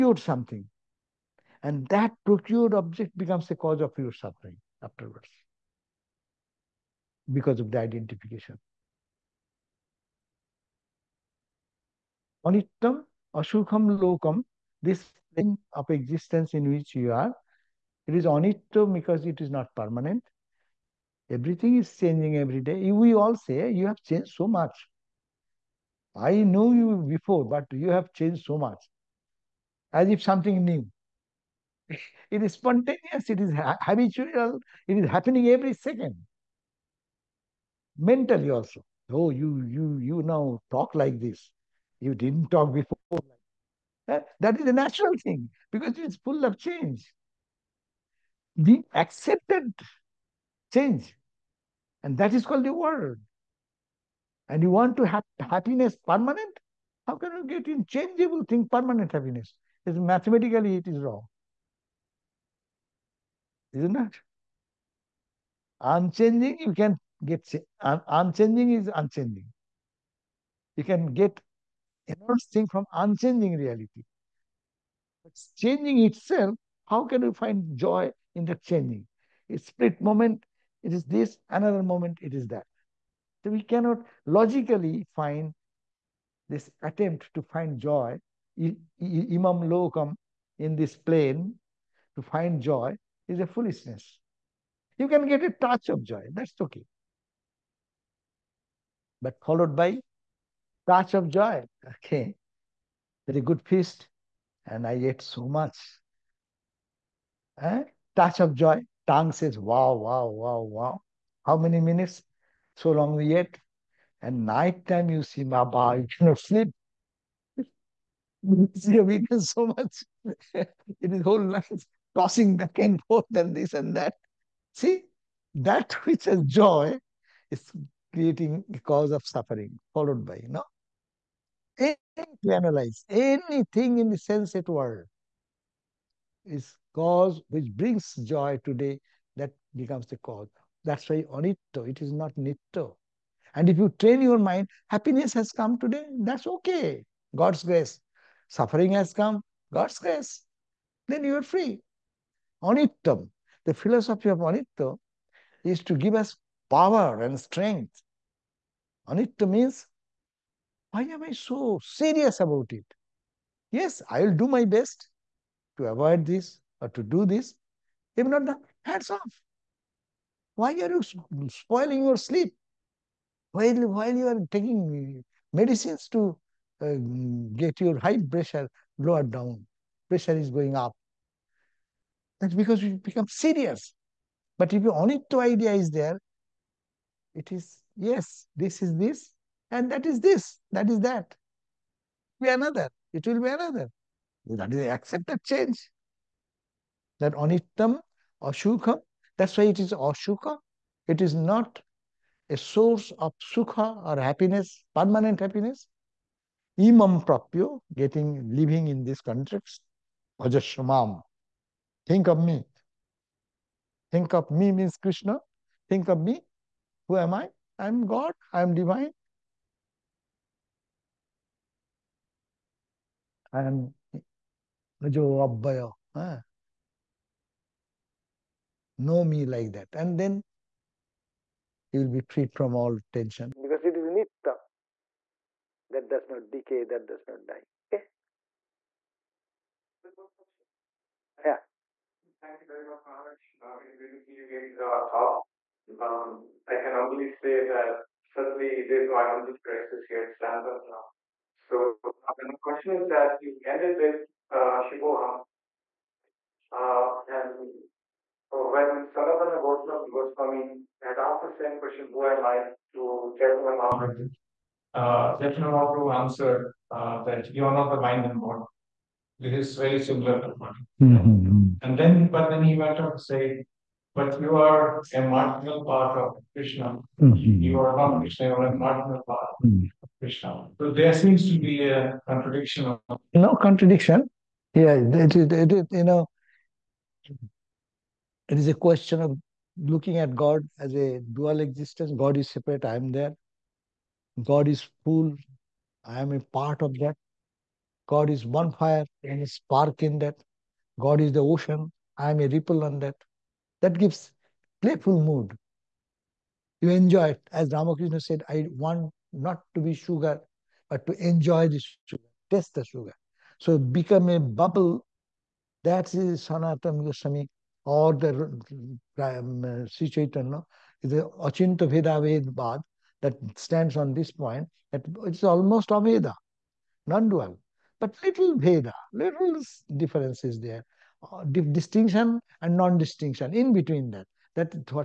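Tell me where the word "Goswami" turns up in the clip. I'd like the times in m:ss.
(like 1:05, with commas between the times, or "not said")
4:20, 5:17.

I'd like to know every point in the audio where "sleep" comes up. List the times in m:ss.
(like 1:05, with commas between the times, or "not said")
1:56, 2:52.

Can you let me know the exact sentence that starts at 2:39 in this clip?
Onitto means why am I so serious about it?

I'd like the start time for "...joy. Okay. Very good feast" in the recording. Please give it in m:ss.
1:41.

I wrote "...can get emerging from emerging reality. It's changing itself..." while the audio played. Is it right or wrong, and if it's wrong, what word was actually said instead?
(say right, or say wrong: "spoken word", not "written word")
wrong: "unchanging", not "emerging".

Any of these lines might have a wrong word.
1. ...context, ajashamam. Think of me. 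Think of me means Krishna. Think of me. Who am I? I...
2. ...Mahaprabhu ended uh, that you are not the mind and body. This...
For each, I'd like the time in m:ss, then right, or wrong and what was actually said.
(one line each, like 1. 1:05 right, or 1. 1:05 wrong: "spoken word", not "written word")
1. 3:29 right
2. 4:25 wrong: "answered", not "ended".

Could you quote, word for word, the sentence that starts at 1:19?
It's split moment, it is this, another moment, it is that.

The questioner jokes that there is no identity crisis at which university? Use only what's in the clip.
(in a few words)
Stanford.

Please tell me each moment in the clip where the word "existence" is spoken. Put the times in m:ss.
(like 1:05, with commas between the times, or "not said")
0:15, 4:51.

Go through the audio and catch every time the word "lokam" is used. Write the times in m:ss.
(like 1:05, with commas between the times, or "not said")
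0:13, 1:29.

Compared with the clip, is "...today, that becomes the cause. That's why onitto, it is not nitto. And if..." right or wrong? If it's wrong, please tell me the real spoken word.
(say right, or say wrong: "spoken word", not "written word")
right.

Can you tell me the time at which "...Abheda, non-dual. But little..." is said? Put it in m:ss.
5:25.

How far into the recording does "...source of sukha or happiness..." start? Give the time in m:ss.
3:22.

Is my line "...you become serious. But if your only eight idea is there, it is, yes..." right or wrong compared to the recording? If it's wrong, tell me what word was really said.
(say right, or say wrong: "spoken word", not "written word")
wrong: "two", not "eight".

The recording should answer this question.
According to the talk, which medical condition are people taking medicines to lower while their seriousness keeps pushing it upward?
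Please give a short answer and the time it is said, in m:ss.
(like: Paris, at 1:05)
High pressure, at 2:57.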